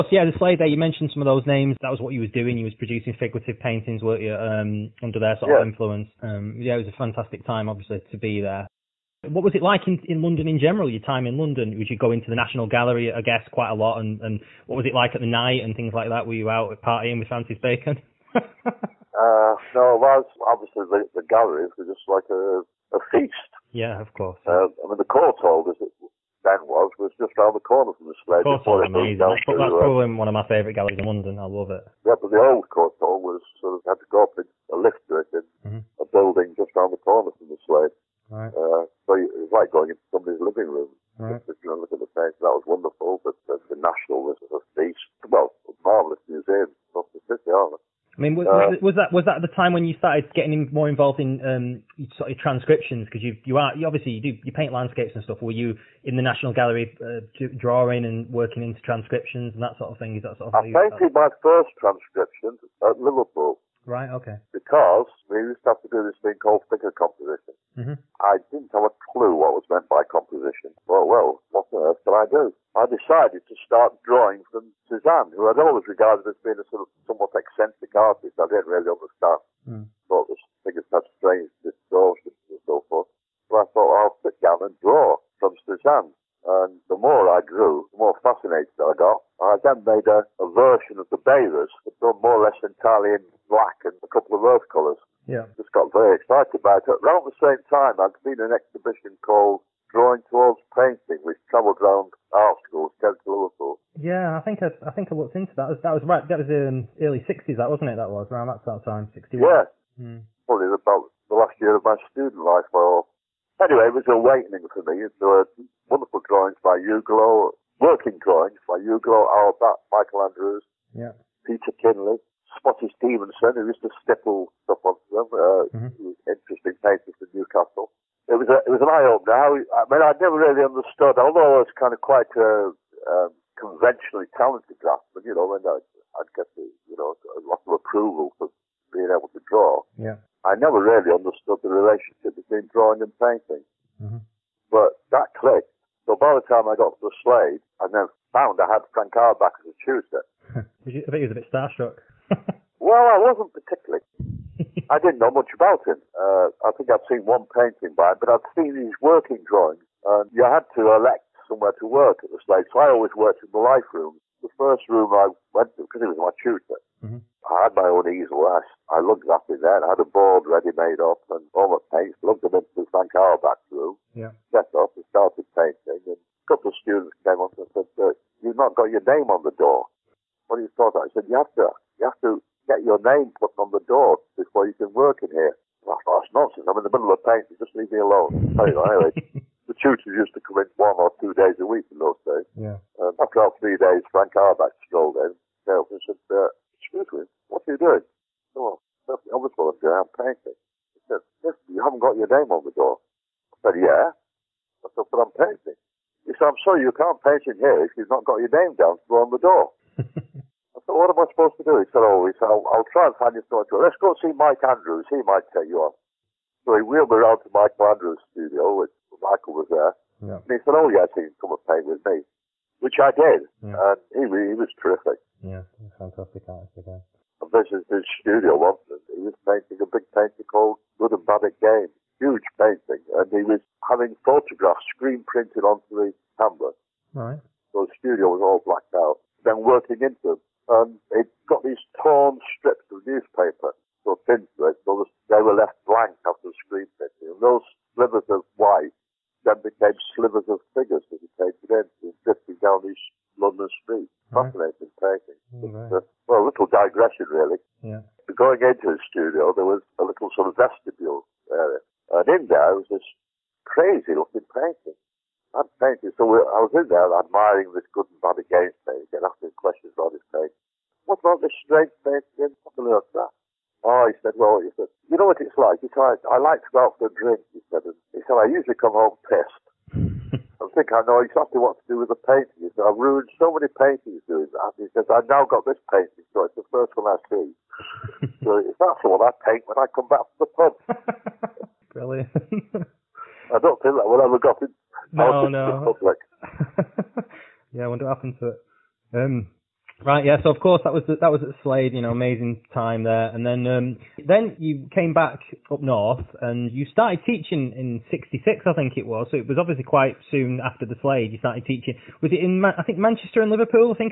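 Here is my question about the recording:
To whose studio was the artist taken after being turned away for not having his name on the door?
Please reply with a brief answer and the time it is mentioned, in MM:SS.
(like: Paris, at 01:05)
Mike Andrews, at 03:34.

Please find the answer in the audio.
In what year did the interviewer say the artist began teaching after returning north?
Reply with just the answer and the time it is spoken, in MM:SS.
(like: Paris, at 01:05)
1966, at 05:08.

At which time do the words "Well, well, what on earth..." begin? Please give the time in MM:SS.
01:10.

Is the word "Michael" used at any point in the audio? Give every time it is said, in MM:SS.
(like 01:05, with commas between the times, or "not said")
01:59, 03:39.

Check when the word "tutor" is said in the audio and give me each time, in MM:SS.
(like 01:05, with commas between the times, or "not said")
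02:29, 02:46, 03:09.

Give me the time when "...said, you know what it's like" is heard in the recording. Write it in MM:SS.
04:34.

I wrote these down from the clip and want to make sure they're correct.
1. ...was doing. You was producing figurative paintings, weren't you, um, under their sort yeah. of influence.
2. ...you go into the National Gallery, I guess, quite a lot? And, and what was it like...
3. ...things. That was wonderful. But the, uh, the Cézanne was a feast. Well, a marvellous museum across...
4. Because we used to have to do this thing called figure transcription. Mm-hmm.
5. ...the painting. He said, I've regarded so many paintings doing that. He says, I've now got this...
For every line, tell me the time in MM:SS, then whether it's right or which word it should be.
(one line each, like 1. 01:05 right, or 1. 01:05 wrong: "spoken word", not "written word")
1. 00:02 right
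2. 00:11 right
3. 00:42 wrong: "National", not "Cézanne"
4. 01:04 wrong: "composition", not "transcription"
5. 04:42 wrong: "ruined", not "regarded".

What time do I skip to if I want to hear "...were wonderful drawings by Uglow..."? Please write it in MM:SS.
01:55.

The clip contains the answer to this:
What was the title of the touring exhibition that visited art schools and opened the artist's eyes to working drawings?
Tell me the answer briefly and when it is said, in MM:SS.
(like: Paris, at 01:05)
Drawing Towards Painting, at 01:39.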